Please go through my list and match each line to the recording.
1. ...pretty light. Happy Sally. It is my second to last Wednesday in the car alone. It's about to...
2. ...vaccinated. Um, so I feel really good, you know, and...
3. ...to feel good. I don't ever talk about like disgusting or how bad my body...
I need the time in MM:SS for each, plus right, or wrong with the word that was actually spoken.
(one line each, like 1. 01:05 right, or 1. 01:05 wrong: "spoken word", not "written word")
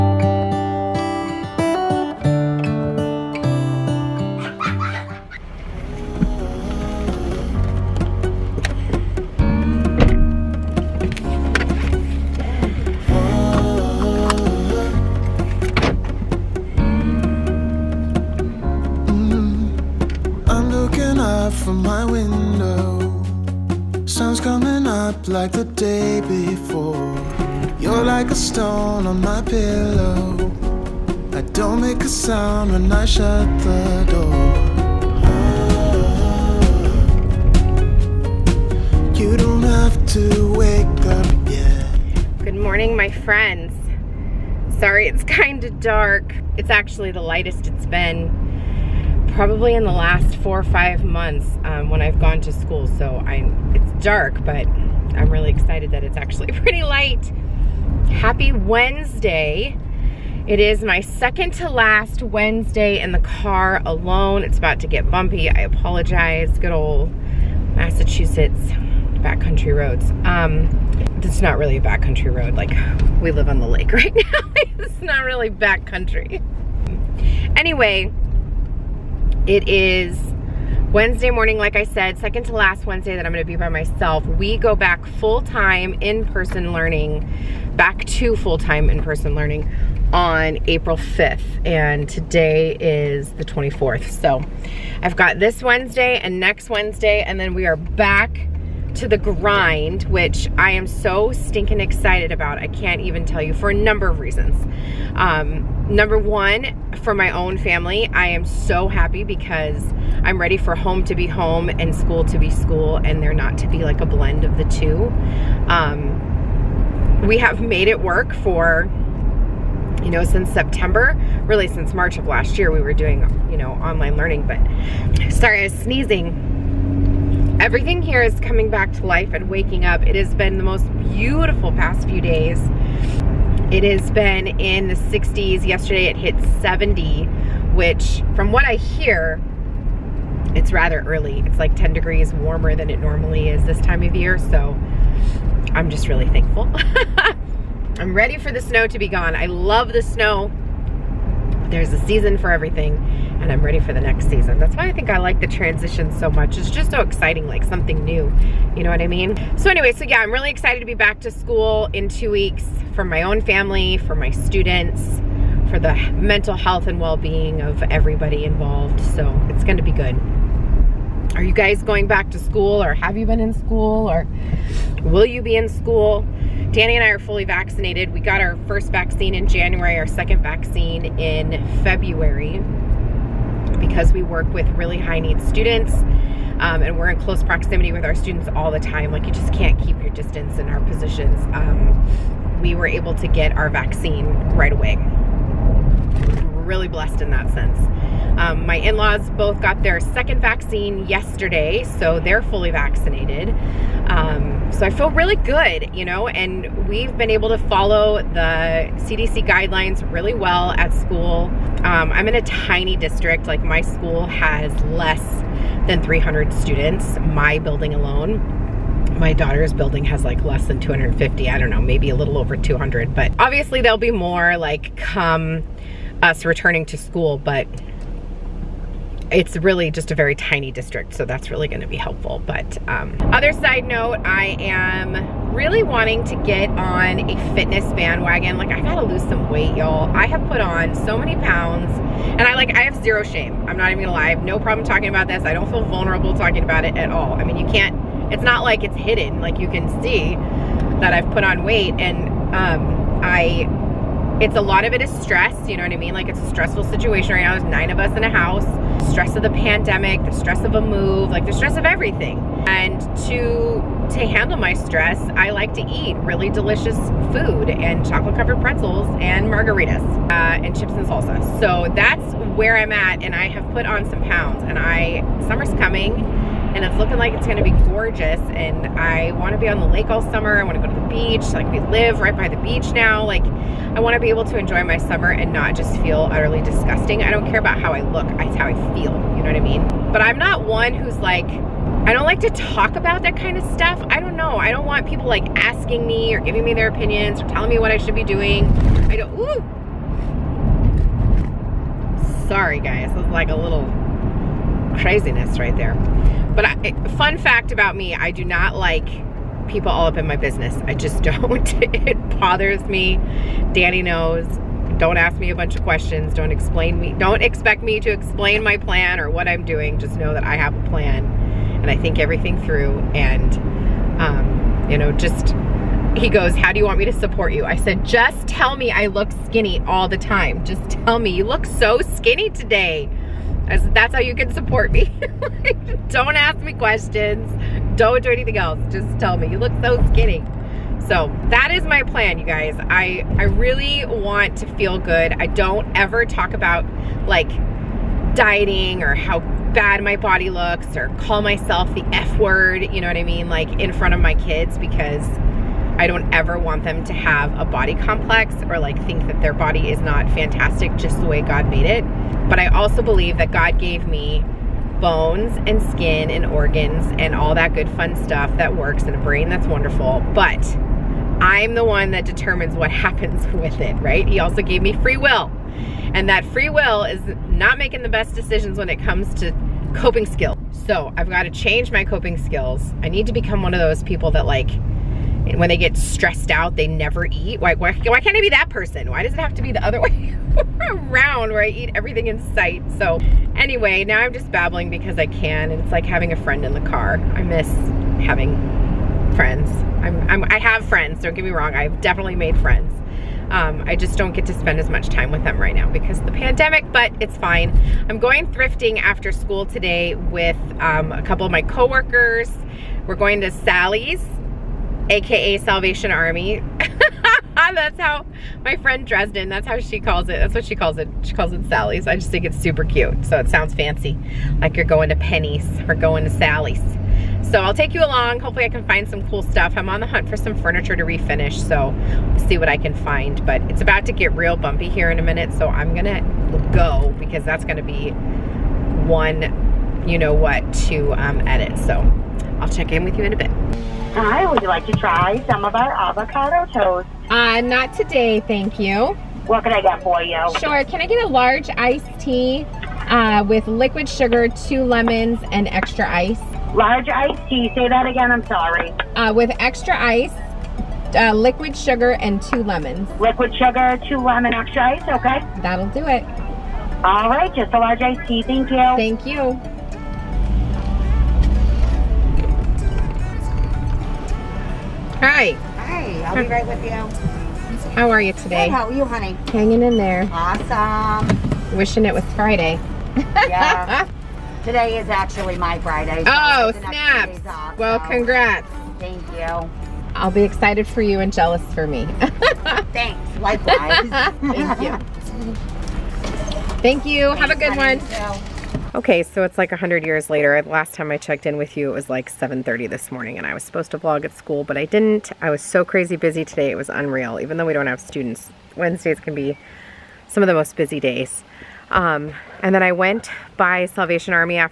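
1. 00:56 wrong: "Wednesday", not "Sally"
2. 03:22 right
3. 05:44 wrong: "dieting", not "disgusting".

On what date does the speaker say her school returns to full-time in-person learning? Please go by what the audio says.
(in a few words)
April 5th.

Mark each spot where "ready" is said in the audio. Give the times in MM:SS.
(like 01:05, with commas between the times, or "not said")
01:50, 02:28, 02:33.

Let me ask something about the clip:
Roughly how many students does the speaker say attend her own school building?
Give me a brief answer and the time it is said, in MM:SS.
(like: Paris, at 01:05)
less than 300, at 03:34.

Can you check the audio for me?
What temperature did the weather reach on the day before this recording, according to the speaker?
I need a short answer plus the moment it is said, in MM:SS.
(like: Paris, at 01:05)
70, at 02:16.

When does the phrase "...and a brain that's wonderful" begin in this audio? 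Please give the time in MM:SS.
06:09.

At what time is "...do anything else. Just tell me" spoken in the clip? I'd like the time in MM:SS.
05:38.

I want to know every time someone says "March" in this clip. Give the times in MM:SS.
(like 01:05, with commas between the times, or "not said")
02:01.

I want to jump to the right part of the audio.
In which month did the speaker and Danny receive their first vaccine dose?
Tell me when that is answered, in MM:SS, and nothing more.
02:59.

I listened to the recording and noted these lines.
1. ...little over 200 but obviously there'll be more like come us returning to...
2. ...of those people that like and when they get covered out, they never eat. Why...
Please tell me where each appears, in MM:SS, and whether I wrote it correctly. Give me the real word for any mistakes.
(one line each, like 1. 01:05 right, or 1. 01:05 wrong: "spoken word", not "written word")
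1. 03:42 right
2. 06:23 wrong: "stressed", not "covered".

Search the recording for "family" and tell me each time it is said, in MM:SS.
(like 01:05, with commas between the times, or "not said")
01:47, 02:43.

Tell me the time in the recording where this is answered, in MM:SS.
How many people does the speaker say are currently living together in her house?
04:17.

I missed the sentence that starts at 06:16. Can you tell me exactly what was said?
And that free will is not making the best decisions when it comes to coping skills.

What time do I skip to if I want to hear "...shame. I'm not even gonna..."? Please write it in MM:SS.
04:03.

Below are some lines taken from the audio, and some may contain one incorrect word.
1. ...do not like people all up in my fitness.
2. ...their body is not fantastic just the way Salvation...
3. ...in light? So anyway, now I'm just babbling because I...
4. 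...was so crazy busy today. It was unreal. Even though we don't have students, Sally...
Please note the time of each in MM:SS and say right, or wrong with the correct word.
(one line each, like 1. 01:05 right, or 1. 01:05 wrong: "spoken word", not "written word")
1. 05:08 wrong: "business", not "fitness"
2. 05:59 wrong: "God", not "Salvation"
3. 06:32 wrong: "sight", not "light"
4. 08:25 wrong: "Wednesdays", not "Sally".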